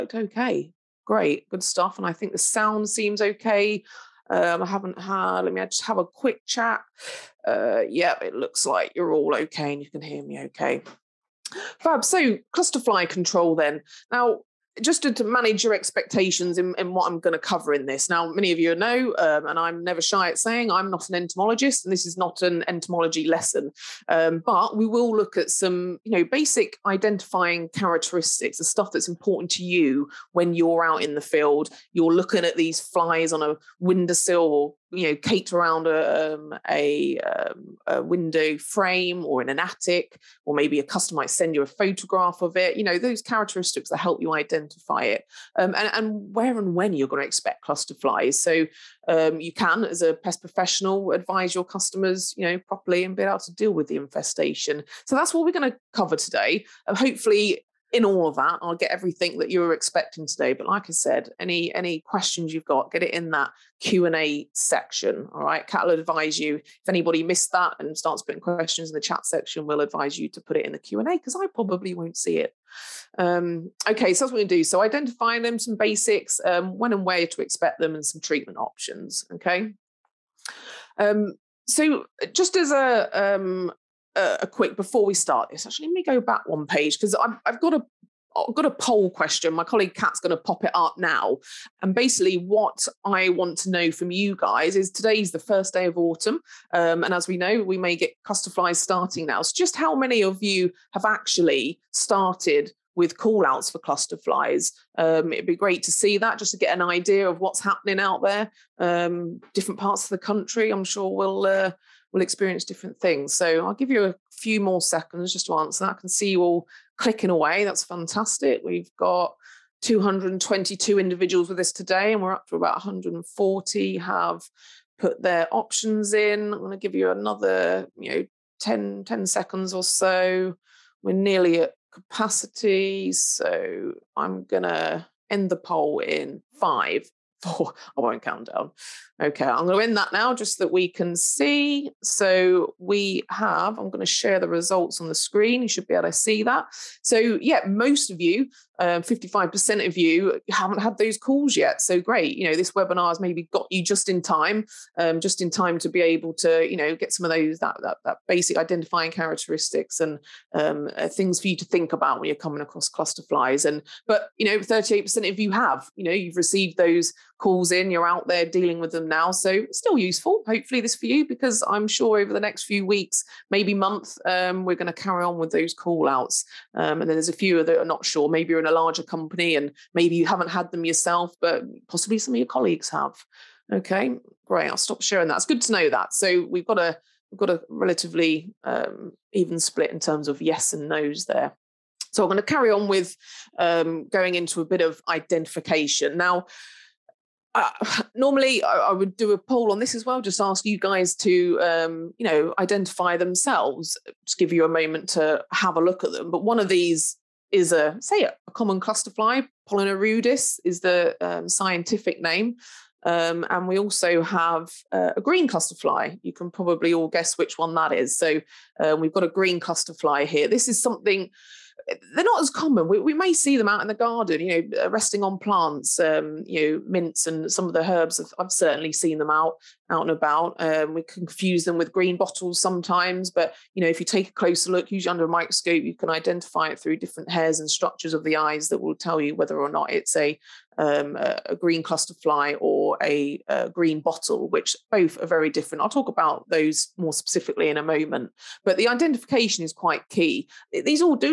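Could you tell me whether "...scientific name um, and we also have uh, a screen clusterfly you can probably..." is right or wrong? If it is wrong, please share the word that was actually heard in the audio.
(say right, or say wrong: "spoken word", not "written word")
wrong: "green", not "screen".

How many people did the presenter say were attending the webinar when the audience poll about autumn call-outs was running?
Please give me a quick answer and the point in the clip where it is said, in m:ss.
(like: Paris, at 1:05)
222, at 1:59.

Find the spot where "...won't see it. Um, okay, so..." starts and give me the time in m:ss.
1:11.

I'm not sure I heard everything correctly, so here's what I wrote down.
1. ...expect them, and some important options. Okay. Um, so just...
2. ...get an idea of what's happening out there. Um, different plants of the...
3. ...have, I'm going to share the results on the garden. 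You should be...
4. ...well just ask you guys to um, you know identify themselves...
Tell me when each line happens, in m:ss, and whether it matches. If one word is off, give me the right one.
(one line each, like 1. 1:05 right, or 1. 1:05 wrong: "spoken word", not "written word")
1. 1:17 wrong: "treatment", not "important"
2. 1:46 wrong: "parts", not "plants"
3. 2:23 wrong: "screen", not "garden"
4. 3:20 right.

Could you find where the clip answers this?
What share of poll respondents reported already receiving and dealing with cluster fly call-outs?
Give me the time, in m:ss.
2:44.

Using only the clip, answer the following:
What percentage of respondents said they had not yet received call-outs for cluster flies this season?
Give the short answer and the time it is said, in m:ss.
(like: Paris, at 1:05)
55%, at 2:28.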